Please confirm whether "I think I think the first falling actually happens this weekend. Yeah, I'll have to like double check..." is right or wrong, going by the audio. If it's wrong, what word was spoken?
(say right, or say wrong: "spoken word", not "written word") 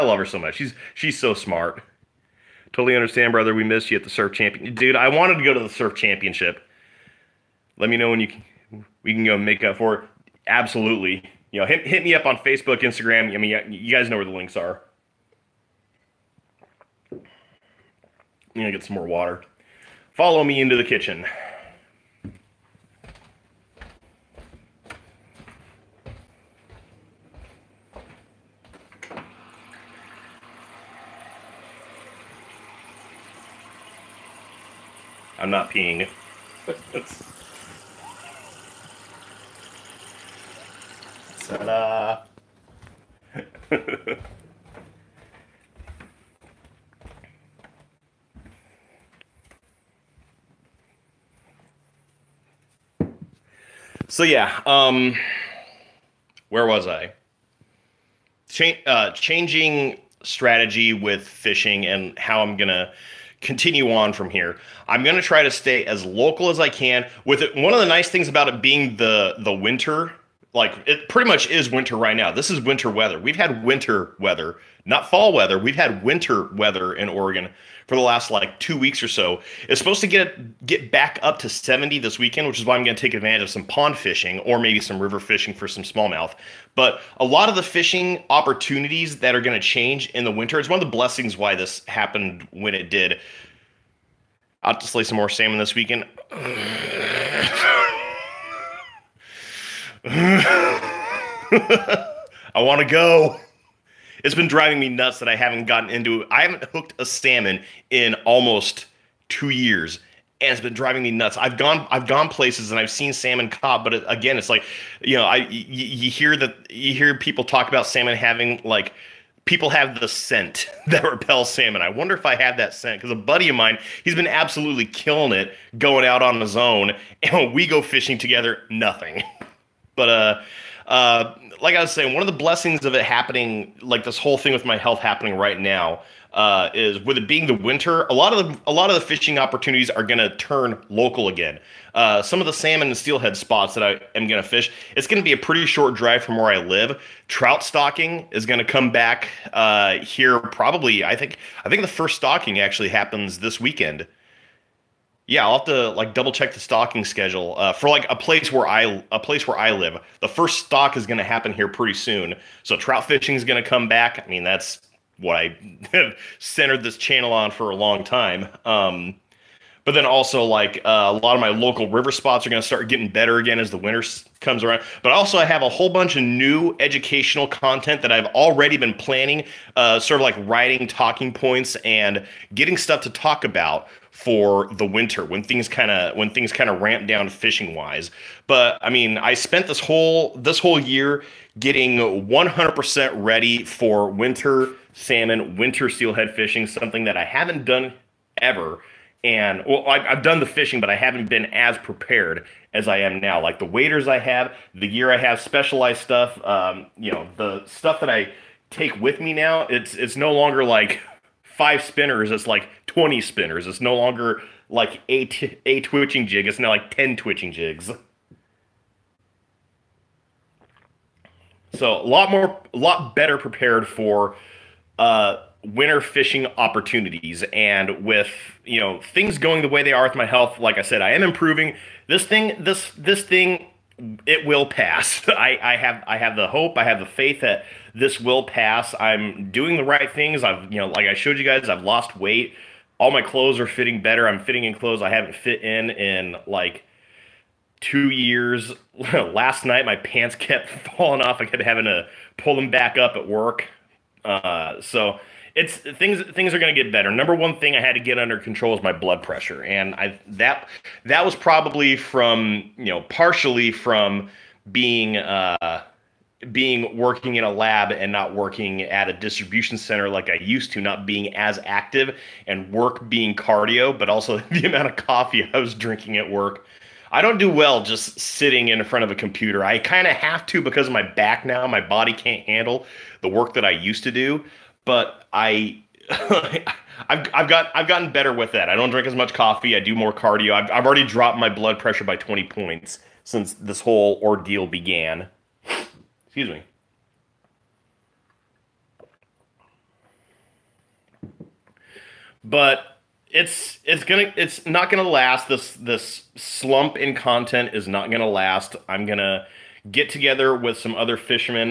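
wrong: "stocking", not "falling".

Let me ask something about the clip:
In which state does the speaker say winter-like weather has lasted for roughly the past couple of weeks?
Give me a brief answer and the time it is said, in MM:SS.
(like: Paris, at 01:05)
Oregon, at 01:17.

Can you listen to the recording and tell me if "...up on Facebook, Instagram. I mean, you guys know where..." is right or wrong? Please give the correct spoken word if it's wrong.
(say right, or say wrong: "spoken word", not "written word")
right.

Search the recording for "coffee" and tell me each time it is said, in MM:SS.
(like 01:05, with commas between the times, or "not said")
04:34, 04:49.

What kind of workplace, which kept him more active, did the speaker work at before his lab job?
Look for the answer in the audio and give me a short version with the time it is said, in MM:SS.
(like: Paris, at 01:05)
distribution center, at 04:29.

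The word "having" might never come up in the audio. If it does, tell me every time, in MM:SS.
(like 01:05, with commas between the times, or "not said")
01:58, 04:11.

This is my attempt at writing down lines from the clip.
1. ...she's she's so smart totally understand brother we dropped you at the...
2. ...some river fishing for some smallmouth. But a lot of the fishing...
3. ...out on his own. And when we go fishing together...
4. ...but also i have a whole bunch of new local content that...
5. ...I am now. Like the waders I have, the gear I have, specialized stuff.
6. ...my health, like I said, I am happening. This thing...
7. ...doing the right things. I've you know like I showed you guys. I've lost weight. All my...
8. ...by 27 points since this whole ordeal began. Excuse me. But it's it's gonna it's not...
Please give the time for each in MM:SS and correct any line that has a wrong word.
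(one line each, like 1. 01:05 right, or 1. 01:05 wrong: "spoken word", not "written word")
1. 00:00 wrong: "missed", not "dropped"
2. 01:24 right
3. 02:06 right
4. 02:55 wrong: "educational", not "local"
5. 03:22 right
6. 03:50 wrong: "improving", not "happening"
7. 03:59 right
8. 04:52 wrong: "20", not "27".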